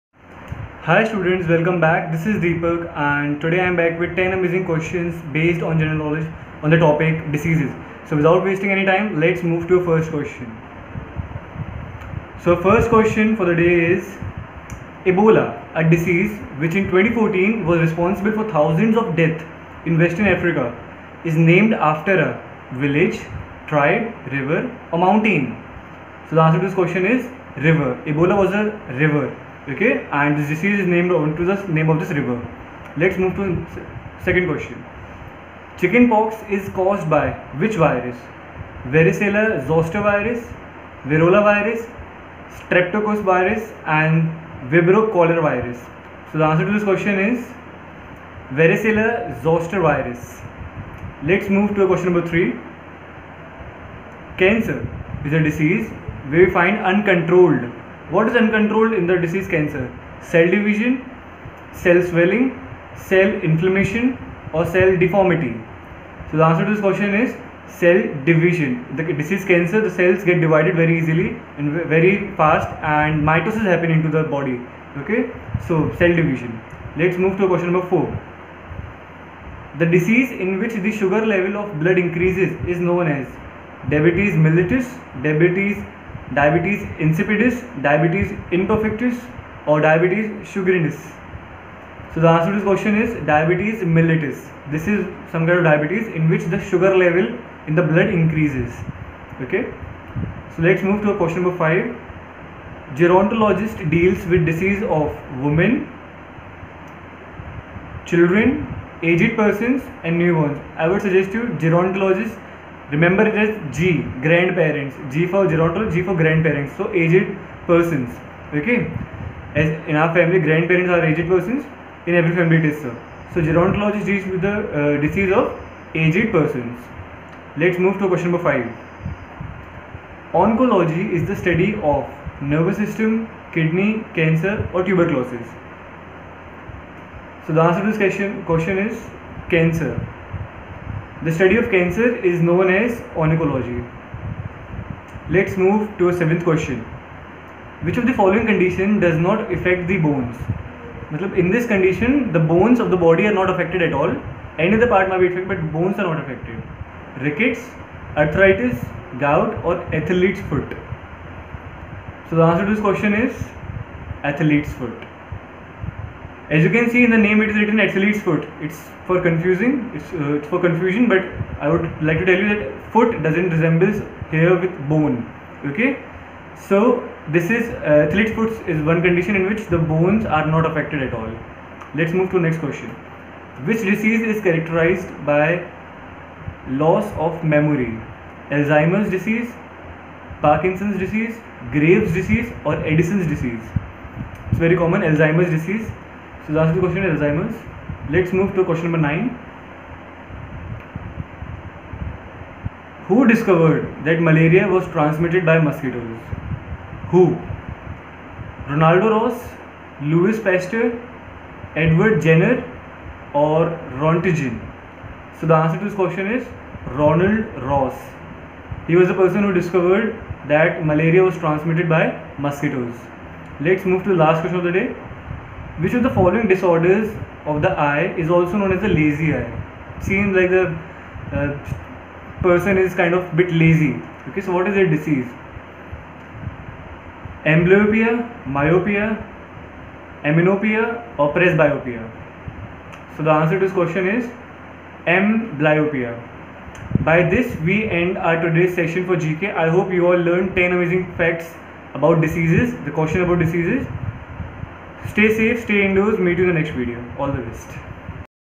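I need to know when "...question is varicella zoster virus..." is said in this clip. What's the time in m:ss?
0:46.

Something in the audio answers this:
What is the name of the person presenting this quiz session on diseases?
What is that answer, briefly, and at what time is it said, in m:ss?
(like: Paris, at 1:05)
Deepak, at 0:02.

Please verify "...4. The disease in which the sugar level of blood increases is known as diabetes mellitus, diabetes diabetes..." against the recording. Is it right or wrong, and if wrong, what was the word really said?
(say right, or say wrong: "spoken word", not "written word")
right.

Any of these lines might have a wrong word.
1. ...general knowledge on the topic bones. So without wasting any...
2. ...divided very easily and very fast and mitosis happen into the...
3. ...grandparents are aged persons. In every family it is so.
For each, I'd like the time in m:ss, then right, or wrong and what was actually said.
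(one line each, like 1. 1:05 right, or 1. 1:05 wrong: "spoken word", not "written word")
1. 0:05 wrong: "diseases", not "bones"
2. 1:10 right
3. 2:00 right.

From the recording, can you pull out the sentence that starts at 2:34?
Any other part may be affected, but bones are not affected.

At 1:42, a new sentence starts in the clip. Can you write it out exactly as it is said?
Gerontologist deals with disease of women, children, aged persons, and newborns.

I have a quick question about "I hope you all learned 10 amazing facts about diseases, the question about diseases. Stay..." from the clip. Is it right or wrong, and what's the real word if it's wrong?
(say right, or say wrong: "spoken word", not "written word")
right.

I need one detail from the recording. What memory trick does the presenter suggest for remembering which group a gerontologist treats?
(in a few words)
G for grandparents.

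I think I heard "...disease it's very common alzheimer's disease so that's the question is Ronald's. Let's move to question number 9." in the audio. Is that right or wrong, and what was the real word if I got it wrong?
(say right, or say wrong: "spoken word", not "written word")
wrong: "Alzheimer", not "Ronald".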